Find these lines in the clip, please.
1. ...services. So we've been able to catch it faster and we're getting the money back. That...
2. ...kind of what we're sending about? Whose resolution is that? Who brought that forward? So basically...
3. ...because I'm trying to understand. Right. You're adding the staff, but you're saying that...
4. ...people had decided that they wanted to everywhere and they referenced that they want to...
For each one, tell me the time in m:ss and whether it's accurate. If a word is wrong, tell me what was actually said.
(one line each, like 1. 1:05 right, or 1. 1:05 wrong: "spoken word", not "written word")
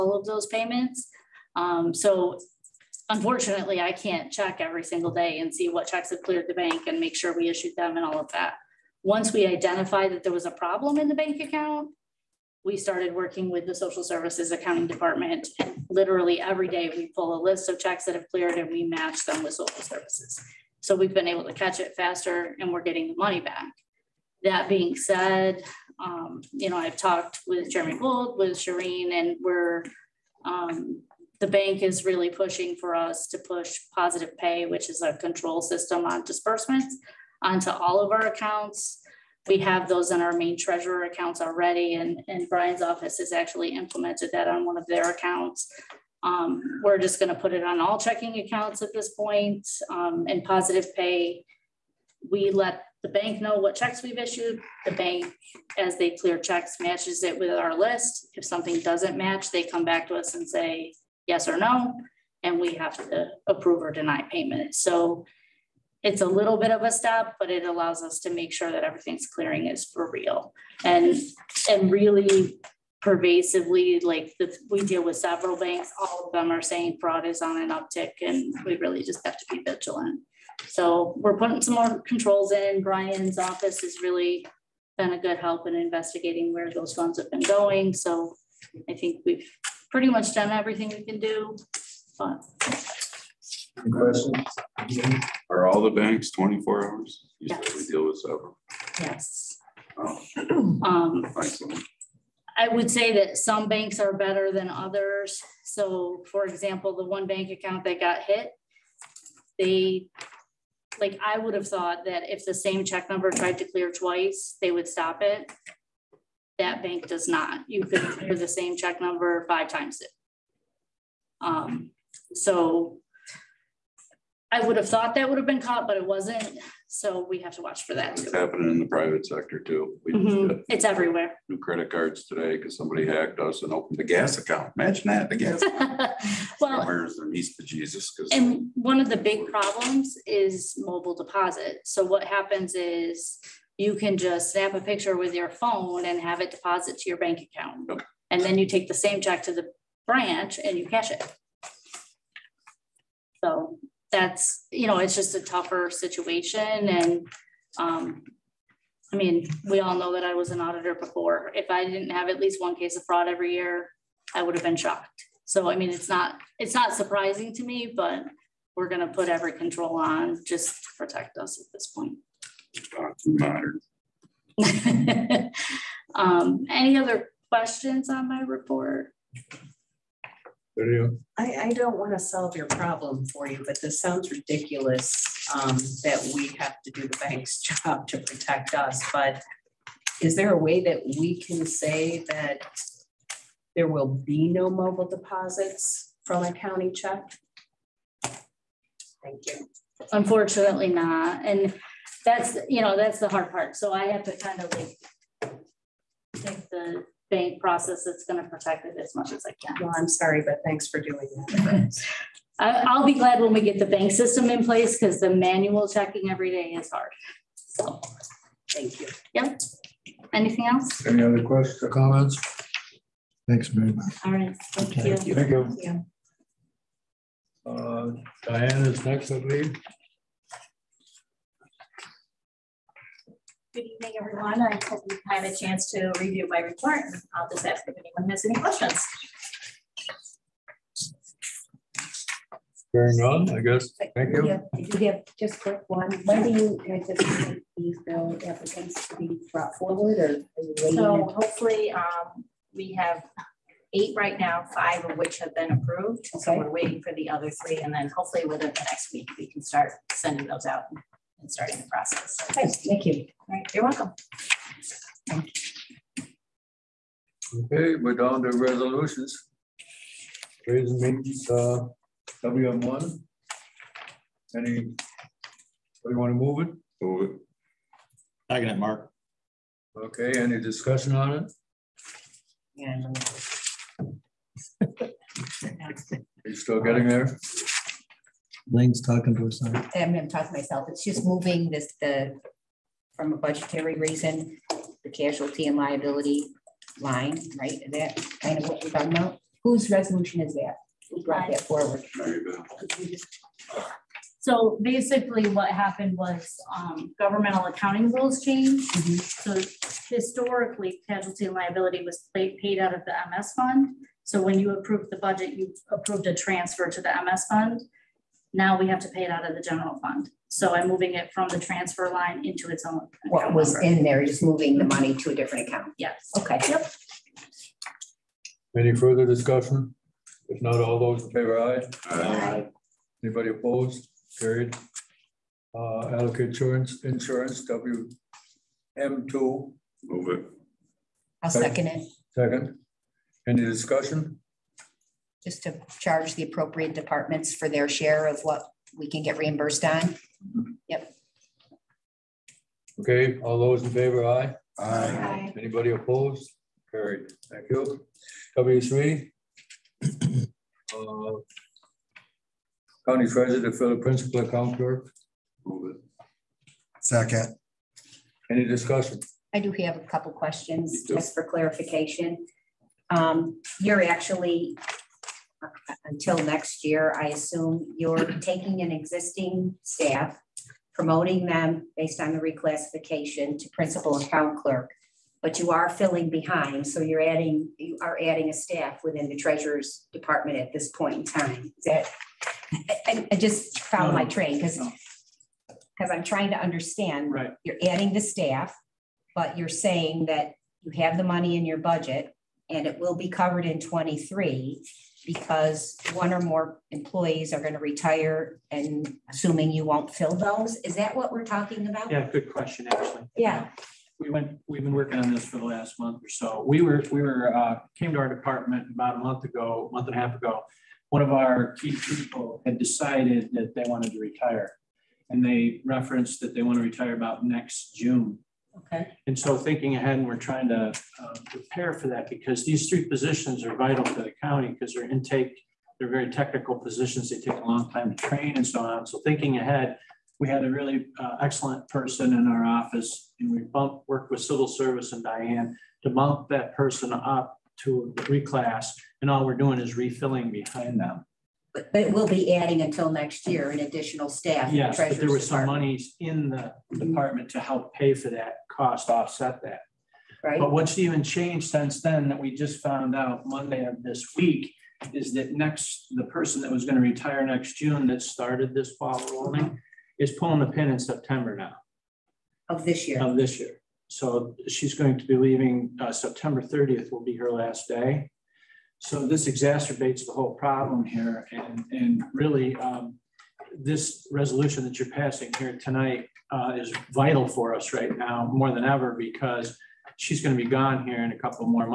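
1. 0:19 right
2. 4:58 wrong: "talking", not "sending"
3. 6:35 right
4. 7:01 wrong: "retire", not "everywhere".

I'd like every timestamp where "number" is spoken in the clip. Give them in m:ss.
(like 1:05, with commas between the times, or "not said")
1:53, 1:59, 5:23.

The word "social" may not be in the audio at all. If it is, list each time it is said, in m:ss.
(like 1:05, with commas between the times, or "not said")
0:13, 0:19.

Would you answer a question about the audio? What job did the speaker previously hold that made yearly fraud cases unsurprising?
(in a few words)
auditor.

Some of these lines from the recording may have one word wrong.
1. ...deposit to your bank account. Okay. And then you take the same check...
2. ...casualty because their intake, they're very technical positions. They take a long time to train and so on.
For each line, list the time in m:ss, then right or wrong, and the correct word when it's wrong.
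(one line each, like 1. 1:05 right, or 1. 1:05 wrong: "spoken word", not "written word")
1. 2:26 right
2. 7:14 wrong: "county", not "casualty".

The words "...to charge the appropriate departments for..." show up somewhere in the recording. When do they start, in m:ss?
5:45.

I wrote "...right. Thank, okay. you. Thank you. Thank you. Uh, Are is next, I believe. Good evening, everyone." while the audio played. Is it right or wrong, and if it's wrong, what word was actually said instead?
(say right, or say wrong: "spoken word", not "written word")
wrong: "Diane", not "Are".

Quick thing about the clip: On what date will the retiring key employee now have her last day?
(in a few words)
September 30th.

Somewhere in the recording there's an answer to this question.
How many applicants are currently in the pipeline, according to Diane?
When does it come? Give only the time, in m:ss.
4:13.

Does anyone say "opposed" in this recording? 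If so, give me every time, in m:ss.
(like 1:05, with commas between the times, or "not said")
5:33, 5:55.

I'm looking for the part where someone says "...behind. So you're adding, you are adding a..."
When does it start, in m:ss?
6:26.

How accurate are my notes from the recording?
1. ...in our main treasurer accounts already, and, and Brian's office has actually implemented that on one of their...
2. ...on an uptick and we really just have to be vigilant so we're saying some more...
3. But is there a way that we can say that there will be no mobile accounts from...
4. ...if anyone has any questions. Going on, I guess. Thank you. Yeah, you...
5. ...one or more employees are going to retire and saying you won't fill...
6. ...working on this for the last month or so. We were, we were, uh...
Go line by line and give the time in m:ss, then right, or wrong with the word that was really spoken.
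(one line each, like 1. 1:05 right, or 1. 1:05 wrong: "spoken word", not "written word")
1. 0:40 right
2. 1:17 wrong: "putting", not "saying"
3. 3:09 wrong: "deposits", not "accounts"
4. 3:57 right
5. 6:46 wrong: "assuming", not "saying"
6. 6:54 right.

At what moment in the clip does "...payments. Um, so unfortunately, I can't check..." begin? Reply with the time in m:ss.
0:00.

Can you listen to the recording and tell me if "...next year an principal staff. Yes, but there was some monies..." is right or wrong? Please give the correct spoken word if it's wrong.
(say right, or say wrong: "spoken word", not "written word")
wrong: "additional", not "principal".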